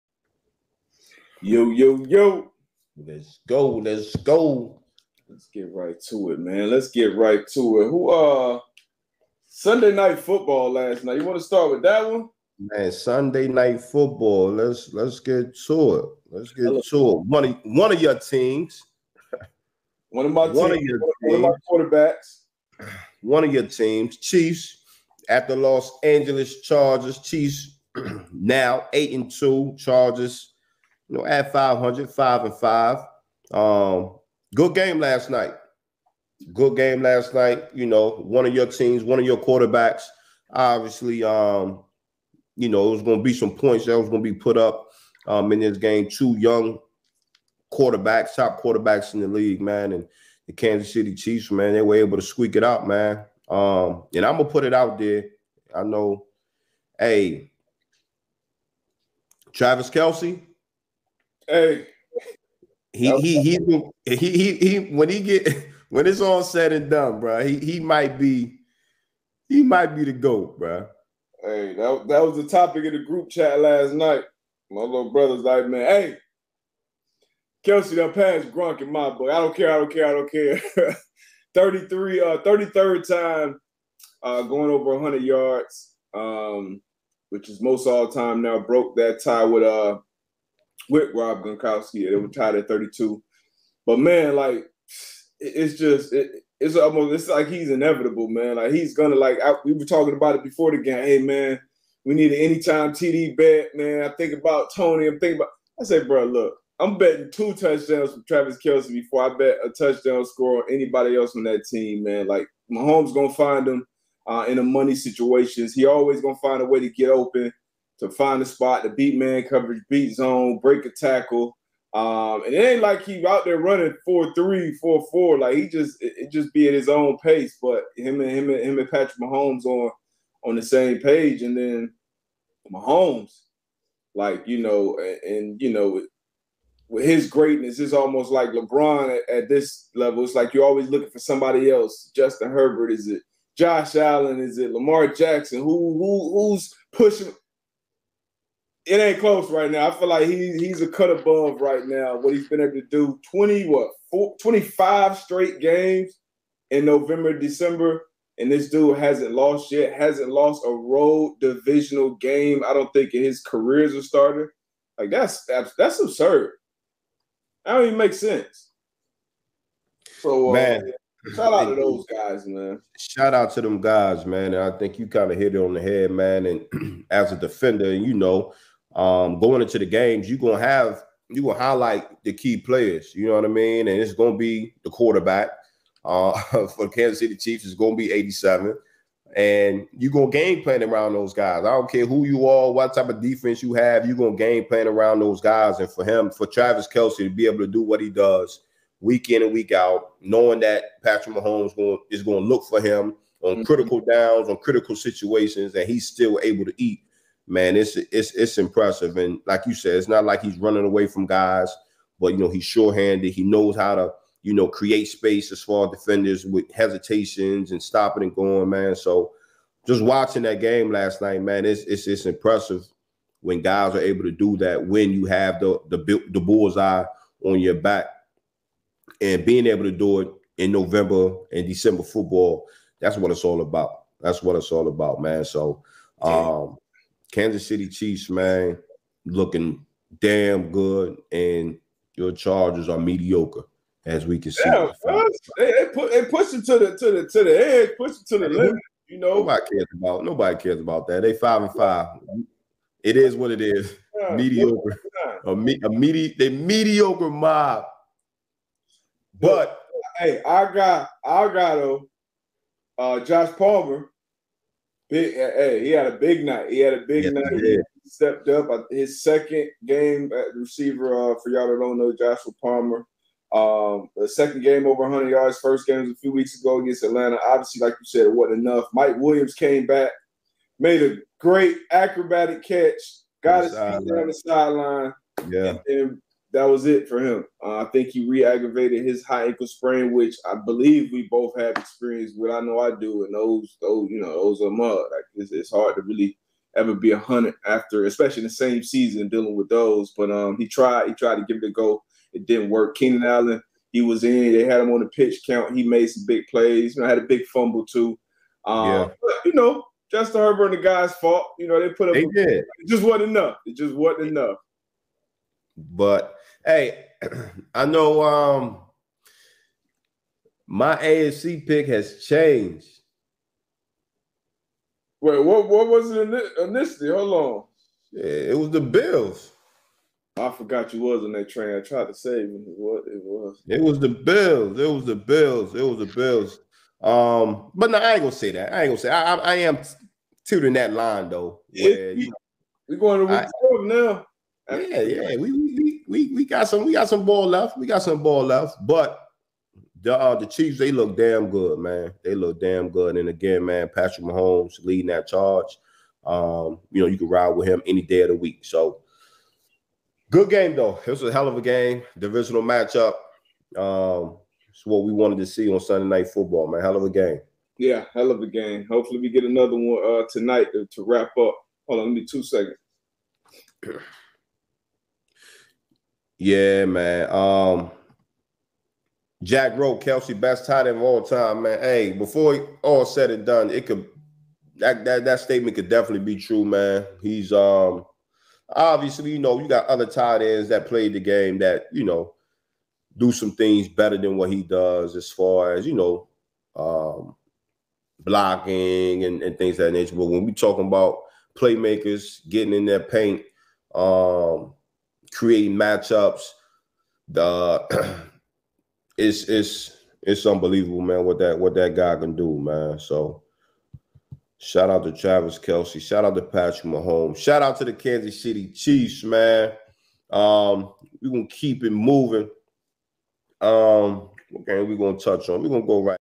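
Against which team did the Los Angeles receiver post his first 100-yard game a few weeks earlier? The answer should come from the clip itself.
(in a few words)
Atlanta.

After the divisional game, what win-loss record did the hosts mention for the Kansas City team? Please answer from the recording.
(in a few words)
8-2.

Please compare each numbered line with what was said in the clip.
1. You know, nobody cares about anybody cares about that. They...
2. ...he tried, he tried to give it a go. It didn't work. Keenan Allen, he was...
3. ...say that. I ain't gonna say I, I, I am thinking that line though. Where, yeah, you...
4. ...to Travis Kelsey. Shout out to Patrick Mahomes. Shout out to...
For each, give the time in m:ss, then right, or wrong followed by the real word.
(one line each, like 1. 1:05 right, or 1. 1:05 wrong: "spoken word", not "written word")
1. 4:09 wrong: "nobody", not "anybody"
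2. 5:00 right
3. 5:38 wrong: "tooting", not "thinking"
4. 6:55 right.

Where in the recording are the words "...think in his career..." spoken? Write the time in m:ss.
2:42.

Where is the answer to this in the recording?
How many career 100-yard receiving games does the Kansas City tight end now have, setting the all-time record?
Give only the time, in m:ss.
1:22.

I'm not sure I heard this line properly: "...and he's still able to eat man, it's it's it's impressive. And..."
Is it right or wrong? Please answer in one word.
right.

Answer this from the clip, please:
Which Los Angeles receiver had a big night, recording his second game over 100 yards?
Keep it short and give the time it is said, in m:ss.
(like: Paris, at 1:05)
Joshua Palmer, at 4:32.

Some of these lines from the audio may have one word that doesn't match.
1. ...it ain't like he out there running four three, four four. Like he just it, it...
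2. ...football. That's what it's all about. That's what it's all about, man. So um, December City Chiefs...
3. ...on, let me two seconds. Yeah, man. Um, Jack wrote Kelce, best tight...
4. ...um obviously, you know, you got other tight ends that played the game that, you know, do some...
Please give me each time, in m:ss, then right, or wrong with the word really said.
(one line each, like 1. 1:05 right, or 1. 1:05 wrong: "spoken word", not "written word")
1. 2:02 right
2. 3:52 wrong: "Kansas", not "December"
3. 6:11 right
4. 6:27 right.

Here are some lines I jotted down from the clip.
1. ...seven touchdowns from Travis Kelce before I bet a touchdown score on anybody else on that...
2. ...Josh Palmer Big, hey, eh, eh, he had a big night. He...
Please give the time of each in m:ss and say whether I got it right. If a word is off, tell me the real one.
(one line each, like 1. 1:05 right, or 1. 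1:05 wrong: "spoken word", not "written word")
1. 1:47 wrong: "two", not "seven"
2. 4:23 right.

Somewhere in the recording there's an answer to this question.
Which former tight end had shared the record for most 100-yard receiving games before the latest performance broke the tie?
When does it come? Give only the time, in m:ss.
1:31.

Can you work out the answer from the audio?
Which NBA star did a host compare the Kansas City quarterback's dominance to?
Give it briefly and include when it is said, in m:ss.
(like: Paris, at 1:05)
LeBron, at 2:18.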